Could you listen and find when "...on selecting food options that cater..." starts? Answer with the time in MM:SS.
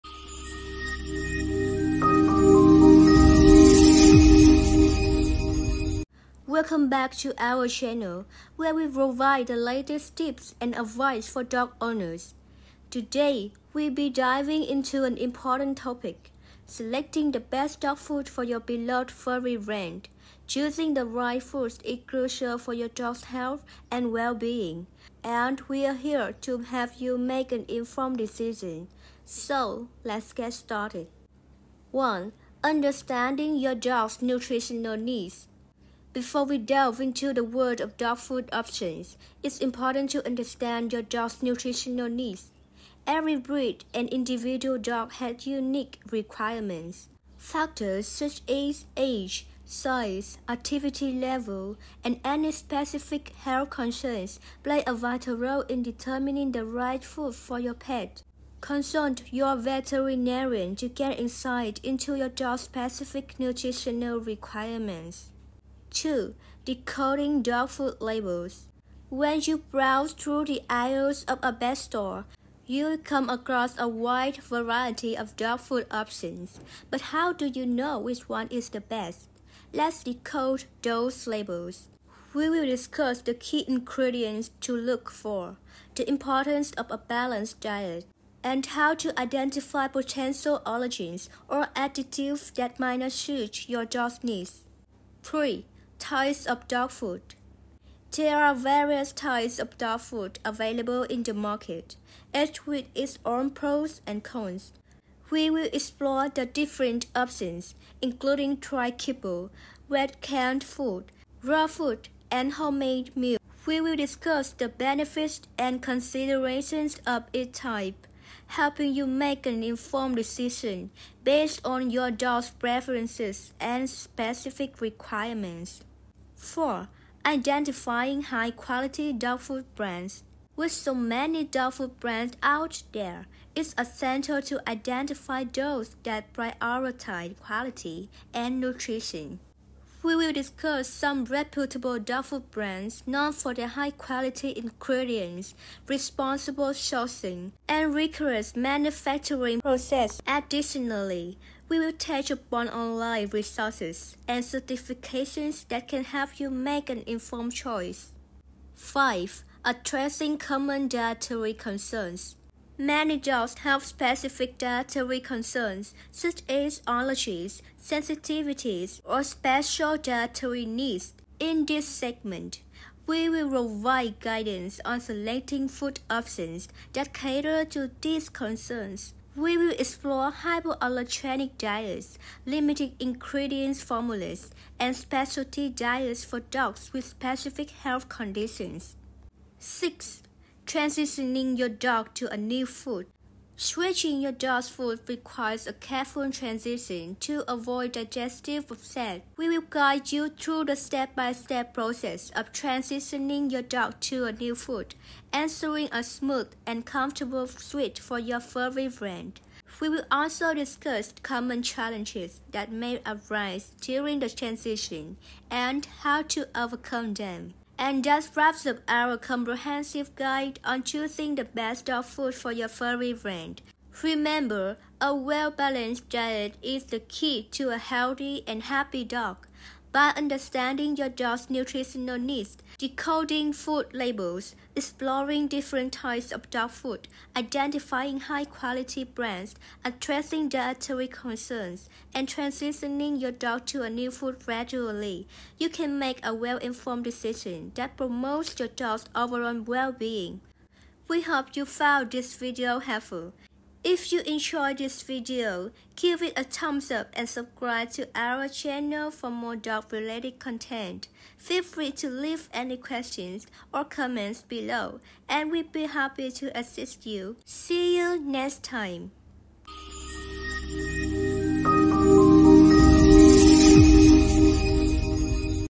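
02:54.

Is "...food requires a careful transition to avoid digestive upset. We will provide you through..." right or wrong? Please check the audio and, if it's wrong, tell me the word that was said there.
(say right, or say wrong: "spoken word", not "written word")
wrong: "guide", not "provide".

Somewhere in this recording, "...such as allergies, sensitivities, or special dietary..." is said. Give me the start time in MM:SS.
02:46.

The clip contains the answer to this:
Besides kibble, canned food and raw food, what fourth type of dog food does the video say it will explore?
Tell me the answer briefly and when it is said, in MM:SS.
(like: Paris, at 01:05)
Homemade meal, at 01:52.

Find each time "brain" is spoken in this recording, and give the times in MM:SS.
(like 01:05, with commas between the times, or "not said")
not said.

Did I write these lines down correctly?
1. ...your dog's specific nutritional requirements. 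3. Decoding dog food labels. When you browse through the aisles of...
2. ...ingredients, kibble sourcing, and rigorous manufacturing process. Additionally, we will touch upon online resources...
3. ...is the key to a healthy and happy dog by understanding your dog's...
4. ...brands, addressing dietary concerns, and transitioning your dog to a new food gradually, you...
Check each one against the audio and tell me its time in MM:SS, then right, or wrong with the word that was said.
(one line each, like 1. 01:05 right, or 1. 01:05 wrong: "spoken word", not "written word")
1. 01:02 wrong: "2", not "3"
2. 02:24 wrong: "responsible", not "kibble"
3. 03:46 right
4. 03:59 right.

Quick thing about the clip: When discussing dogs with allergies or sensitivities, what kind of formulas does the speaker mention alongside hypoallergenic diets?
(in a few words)
Limited ingredients formulas.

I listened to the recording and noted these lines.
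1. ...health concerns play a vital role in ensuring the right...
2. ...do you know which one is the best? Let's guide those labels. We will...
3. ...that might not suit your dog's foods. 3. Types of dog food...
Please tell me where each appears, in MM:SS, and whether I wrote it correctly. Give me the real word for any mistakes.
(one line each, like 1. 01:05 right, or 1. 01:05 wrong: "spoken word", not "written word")
1. 00:53 wrong: "determining", not "ensuring"
2. 01:17 wrong: "decode", not "guide"
3. 01:32 wrong: "needs", not "foods".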